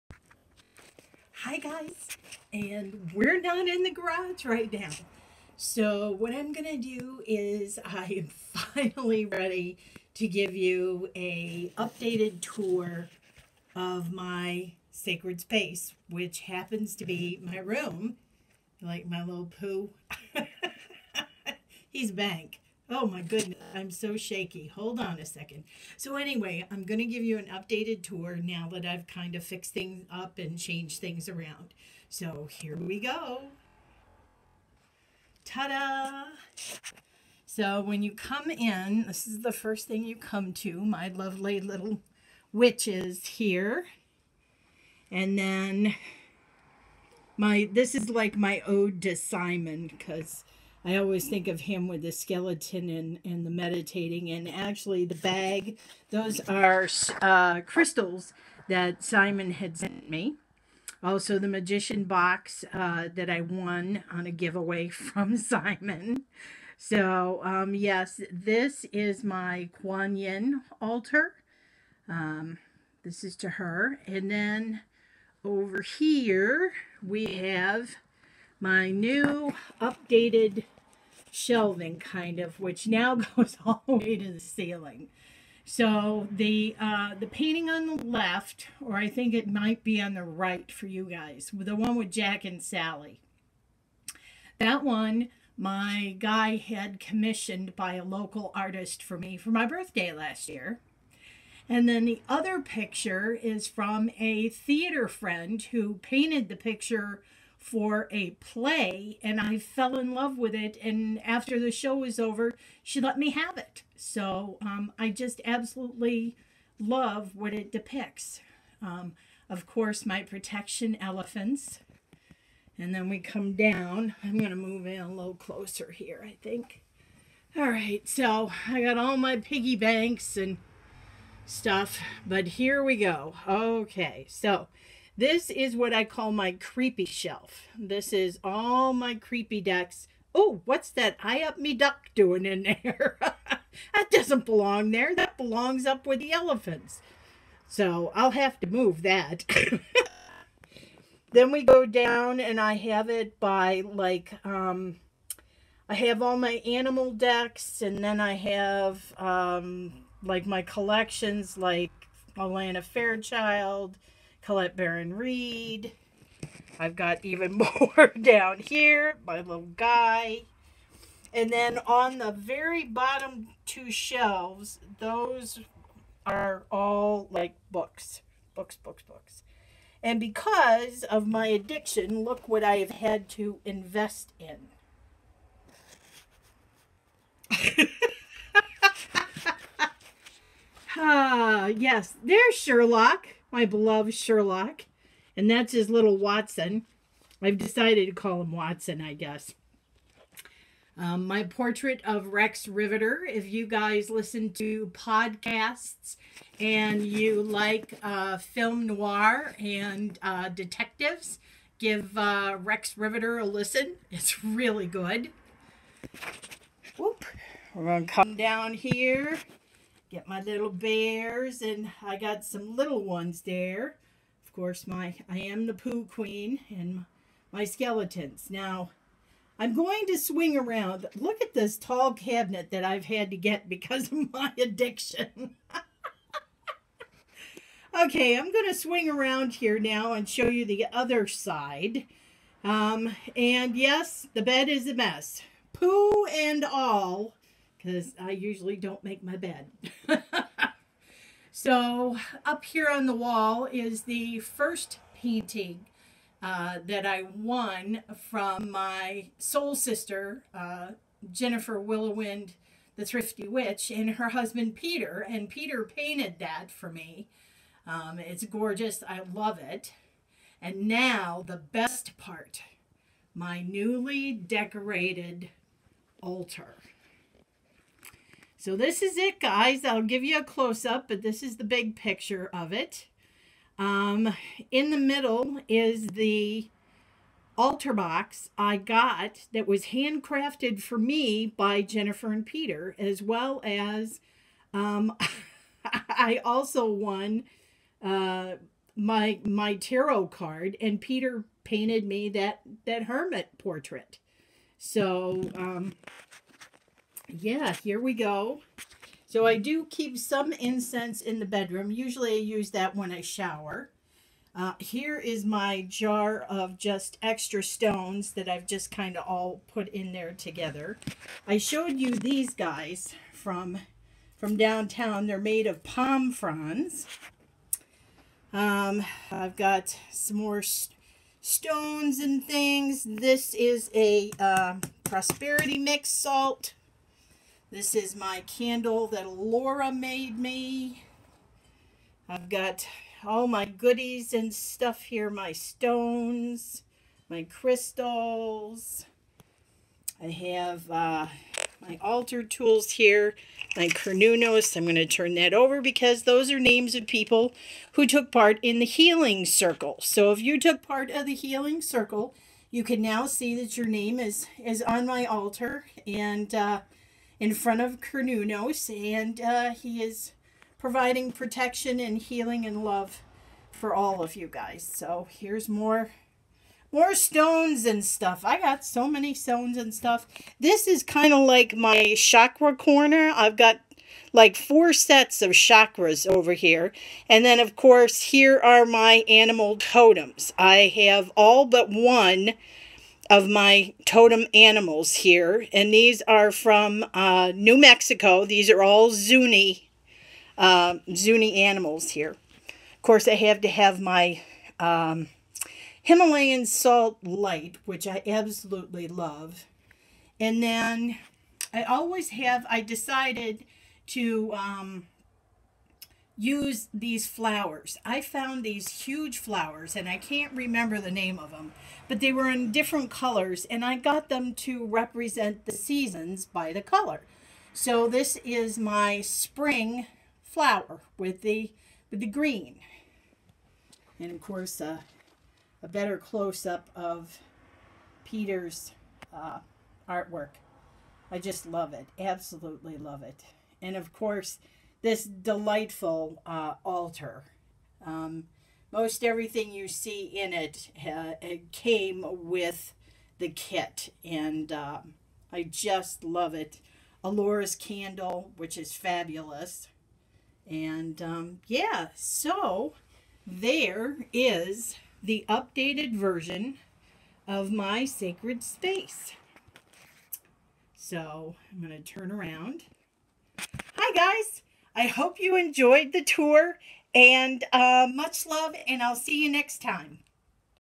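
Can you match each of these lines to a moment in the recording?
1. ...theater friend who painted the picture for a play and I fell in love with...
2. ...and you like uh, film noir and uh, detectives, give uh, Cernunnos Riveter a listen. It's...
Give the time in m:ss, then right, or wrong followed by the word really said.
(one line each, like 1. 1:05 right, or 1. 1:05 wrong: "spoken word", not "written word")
1. 1:44 right
2. 3:26 wrong: "Rex", not "Cernunnos".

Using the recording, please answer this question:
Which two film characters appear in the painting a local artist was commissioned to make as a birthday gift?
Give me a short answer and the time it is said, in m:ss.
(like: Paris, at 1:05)
Jack and Sally, at 1:32.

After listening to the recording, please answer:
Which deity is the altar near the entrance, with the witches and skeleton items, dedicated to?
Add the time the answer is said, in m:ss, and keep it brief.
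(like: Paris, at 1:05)
Kuan Yin, at 1:09.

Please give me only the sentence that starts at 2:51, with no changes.
And then on the very bottom two shelves, those are all like books, books, books, books.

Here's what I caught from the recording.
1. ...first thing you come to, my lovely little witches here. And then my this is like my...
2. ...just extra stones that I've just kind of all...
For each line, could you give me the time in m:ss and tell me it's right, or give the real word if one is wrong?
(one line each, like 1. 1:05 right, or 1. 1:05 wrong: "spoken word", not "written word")
1. 0:39 right
2. 5:16 right.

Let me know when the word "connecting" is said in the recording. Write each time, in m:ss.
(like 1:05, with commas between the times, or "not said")
not said.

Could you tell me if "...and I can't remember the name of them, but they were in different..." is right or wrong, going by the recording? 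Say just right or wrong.
right.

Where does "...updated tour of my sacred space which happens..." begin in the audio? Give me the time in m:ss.
0:11.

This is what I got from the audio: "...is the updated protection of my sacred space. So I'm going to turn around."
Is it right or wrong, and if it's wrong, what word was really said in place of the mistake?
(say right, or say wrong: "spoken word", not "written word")
wrong: "version", not "protection".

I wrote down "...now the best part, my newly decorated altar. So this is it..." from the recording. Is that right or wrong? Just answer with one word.
right.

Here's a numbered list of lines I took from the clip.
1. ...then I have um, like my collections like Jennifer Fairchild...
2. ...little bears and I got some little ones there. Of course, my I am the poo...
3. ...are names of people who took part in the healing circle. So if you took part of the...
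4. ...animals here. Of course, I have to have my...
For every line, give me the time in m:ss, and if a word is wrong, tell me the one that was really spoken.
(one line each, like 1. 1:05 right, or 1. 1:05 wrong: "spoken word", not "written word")
1. 2:38 wrong: "Alana", not "Jennifer"
2. 3:40 right
3. 5:56 right
4. 6:41 right.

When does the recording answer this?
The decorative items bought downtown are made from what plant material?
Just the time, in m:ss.
5:25.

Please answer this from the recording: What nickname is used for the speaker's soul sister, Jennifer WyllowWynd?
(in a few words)
the Thrifty Witch.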